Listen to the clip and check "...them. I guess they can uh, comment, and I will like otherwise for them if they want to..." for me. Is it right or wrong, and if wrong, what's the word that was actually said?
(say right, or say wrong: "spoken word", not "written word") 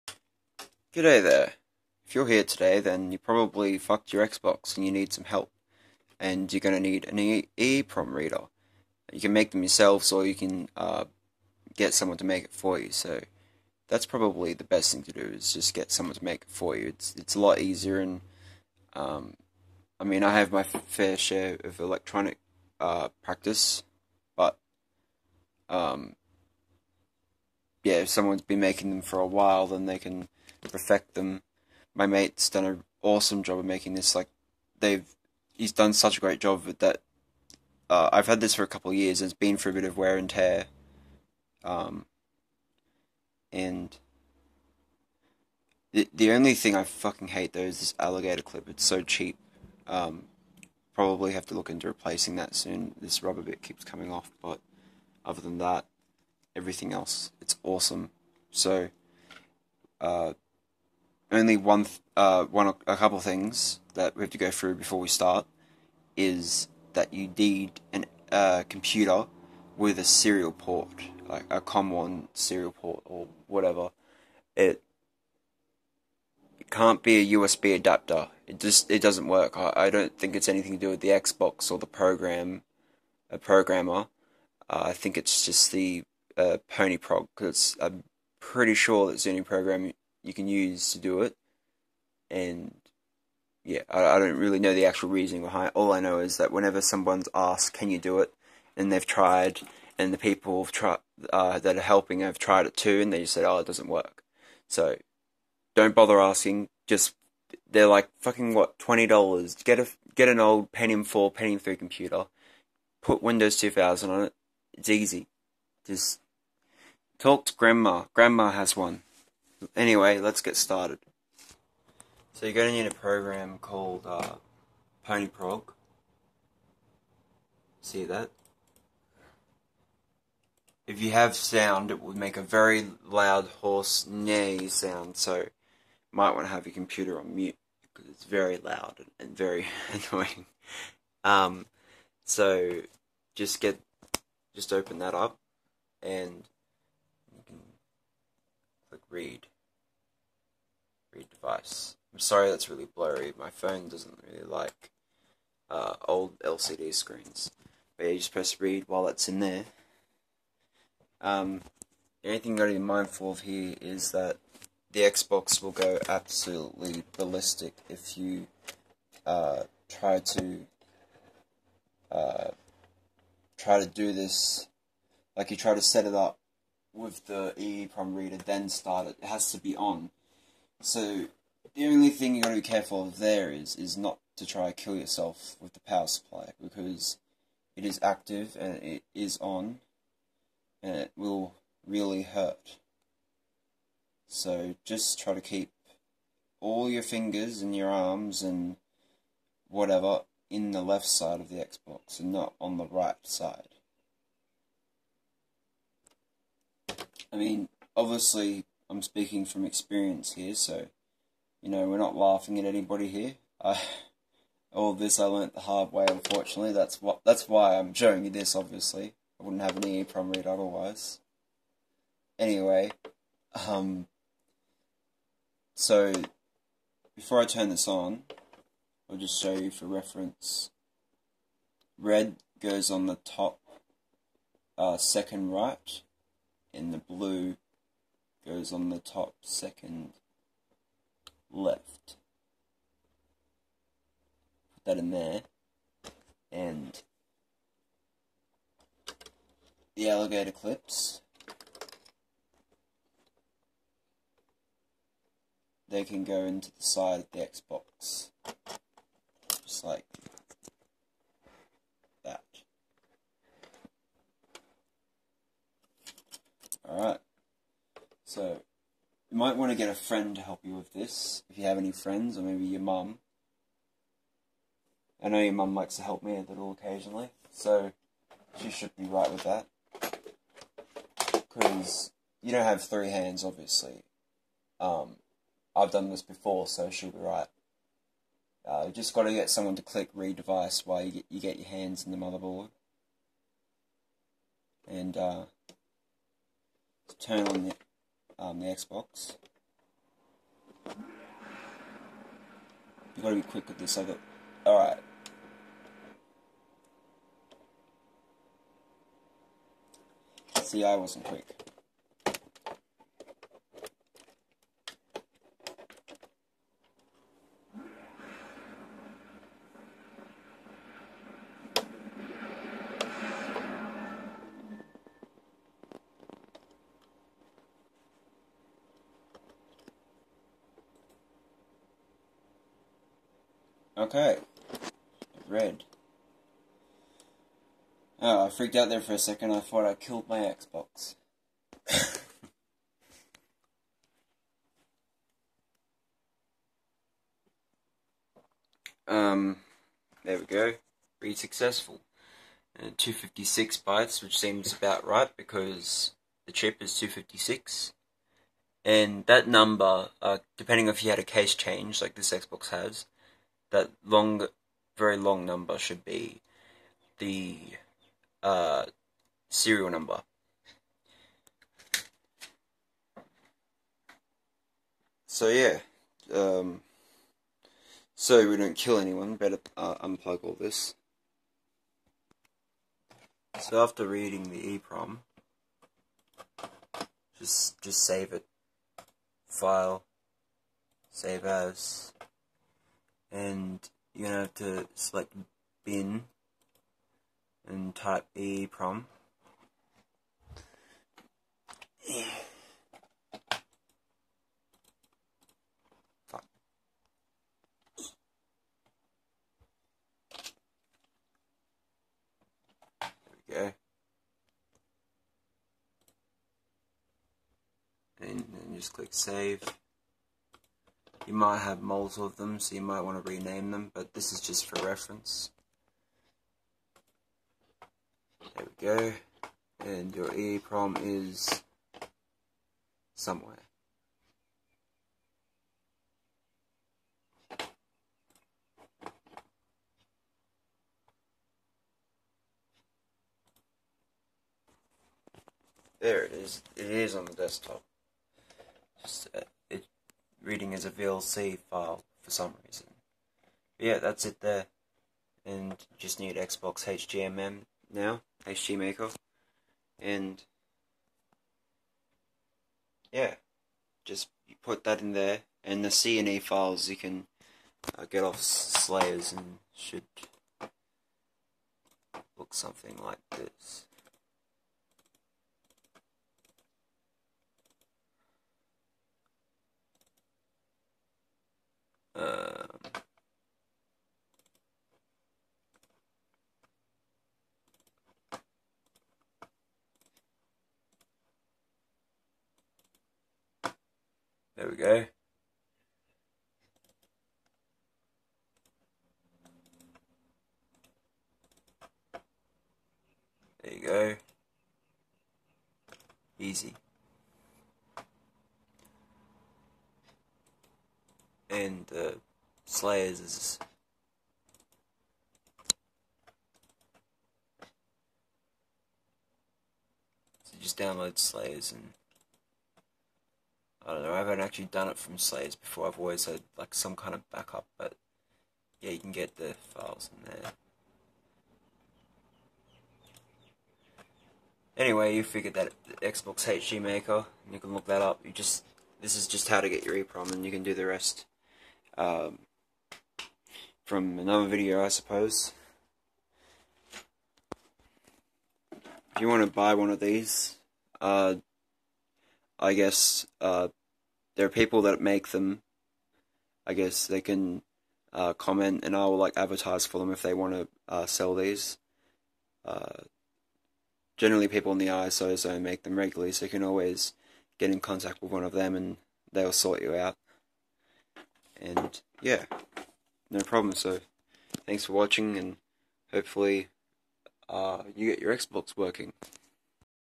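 wrong: "advertise", not "otherwise".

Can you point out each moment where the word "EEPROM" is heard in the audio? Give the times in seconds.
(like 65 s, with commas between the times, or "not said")
7 s, 177 s, 219 s, 384 s, 430 s, 539 s.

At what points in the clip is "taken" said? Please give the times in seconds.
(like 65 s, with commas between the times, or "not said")
not said.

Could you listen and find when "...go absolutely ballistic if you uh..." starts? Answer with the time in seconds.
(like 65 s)
165 s.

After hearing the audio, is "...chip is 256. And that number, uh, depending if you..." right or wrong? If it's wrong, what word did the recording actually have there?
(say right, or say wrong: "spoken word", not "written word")
right.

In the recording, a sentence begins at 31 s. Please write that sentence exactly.
My mate's done an awesome job of making this.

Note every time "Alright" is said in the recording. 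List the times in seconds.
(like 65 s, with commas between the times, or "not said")
266 s, 304 s.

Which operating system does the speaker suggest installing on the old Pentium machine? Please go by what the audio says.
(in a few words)
Windows 2000.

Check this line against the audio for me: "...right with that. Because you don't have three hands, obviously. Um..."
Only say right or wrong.
right.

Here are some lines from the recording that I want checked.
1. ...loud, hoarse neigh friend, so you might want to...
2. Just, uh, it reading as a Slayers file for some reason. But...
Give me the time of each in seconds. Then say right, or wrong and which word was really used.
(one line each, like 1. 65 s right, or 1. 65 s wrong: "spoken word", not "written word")
1. 133 s wrong: "sound", not "friend"
2. 449 s wrong: "VLC", not "Slayers".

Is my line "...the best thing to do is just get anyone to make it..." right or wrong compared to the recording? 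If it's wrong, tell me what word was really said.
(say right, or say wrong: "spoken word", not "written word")
wrong: "someone", not "anyone".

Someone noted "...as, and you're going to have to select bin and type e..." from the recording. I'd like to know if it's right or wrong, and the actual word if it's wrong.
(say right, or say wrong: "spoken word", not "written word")
right.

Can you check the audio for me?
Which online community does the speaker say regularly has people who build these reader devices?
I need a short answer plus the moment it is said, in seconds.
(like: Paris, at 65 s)
ISO zone, at 564 s.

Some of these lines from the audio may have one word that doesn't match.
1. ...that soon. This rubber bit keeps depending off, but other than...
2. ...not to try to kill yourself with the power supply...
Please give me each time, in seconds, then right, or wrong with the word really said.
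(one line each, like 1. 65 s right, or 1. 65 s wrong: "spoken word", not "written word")
1. 52 s wrong: "coming", not "depending"
2. 183 s right.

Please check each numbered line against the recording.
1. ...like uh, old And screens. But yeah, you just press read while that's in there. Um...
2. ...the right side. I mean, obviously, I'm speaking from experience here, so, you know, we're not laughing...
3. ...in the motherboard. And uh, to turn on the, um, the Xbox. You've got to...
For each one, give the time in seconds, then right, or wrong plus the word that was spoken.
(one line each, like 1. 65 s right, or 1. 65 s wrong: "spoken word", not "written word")
1. 154 s wrong: "LCD", not "And"
2. 202 s right
3. 292 s right.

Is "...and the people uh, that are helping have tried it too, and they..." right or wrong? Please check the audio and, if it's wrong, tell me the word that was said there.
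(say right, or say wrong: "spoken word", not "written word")
right.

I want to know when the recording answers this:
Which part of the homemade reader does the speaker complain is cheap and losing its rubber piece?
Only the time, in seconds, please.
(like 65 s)
47 s.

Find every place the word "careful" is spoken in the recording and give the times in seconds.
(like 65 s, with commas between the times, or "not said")
182 s.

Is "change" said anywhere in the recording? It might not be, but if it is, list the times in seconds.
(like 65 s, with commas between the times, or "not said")
361 s.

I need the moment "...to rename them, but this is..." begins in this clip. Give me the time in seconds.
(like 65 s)
423 s.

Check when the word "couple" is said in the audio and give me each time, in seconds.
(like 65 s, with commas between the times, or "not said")
38 s, 62 s.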